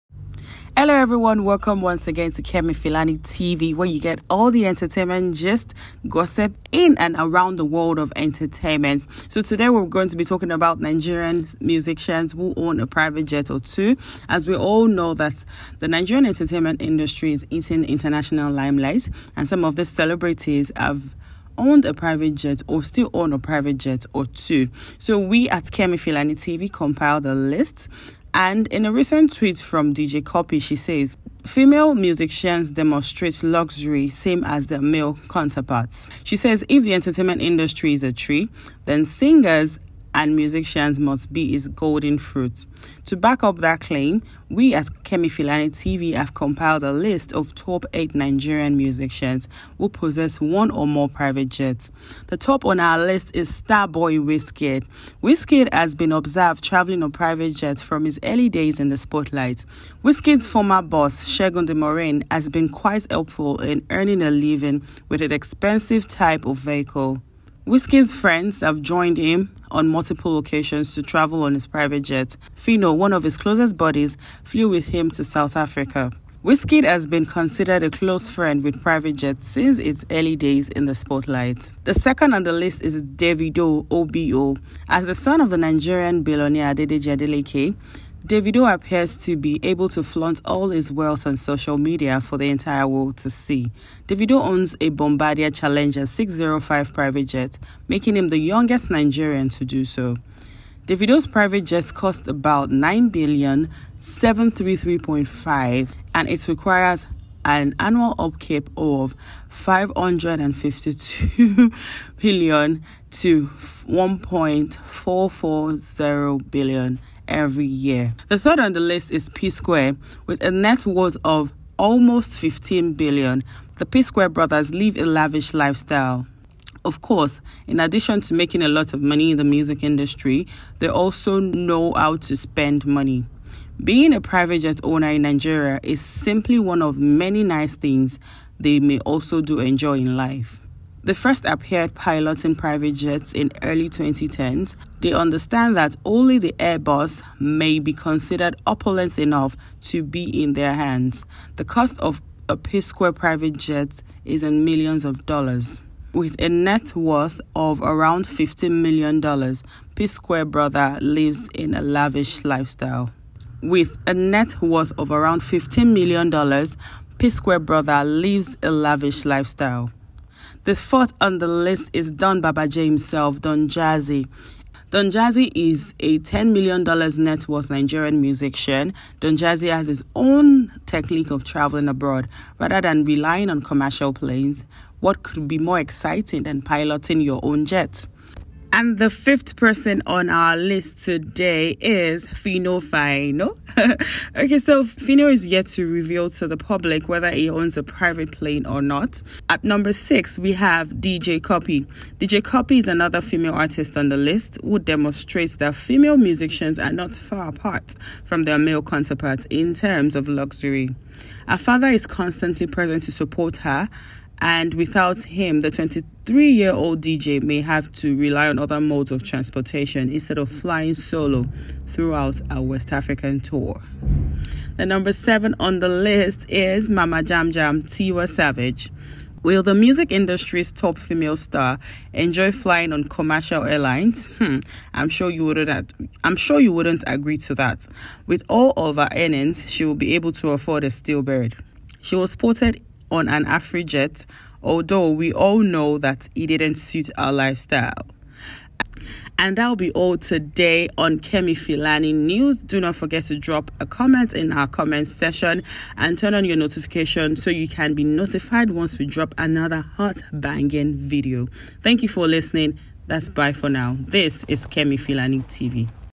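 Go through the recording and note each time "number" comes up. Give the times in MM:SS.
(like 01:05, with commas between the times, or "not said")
03:19, 03:44.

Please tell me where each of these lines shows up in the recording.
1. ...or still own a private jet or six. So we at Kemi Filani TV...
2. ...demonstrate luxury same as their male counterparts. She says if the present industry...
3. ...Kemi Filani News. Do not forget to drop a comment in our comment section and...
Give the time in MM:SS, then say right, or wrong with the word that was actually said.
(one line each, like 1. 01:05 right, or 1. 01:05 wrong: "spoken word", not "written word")
1. 00:22 wrong: "two", not "six"
2. 00:32 wrong: "entertainment", not "present"
3. 04:11 right.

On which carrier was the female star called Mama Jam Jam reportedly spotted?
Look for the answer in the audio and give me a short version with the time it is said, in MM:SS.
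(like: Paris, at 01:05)
AfriJet, at 04:03.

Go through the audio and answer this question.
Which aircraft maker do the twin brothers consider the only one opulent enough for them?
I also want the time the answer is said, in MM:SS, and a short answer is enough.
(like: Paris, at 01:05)
Airbus, at 02:26.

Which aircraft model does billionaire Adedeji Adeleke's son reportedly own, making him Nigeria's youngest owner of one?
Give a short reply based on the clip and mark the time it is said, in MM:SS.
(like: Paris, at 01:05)
Bombardier Challenger 605, at 01:34.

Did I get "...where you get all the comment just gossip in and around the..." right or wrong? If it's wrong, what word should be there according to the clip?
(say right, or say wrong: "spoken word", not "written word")
wrong: "entertainment", not "comment".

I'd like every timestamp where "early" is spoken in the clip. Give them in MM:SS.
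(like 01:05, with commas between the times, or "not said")
00:58, 01:20, 02:23.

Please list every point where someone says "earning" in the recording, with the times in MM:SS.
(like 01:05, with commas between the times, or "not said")
01:03, 03:59.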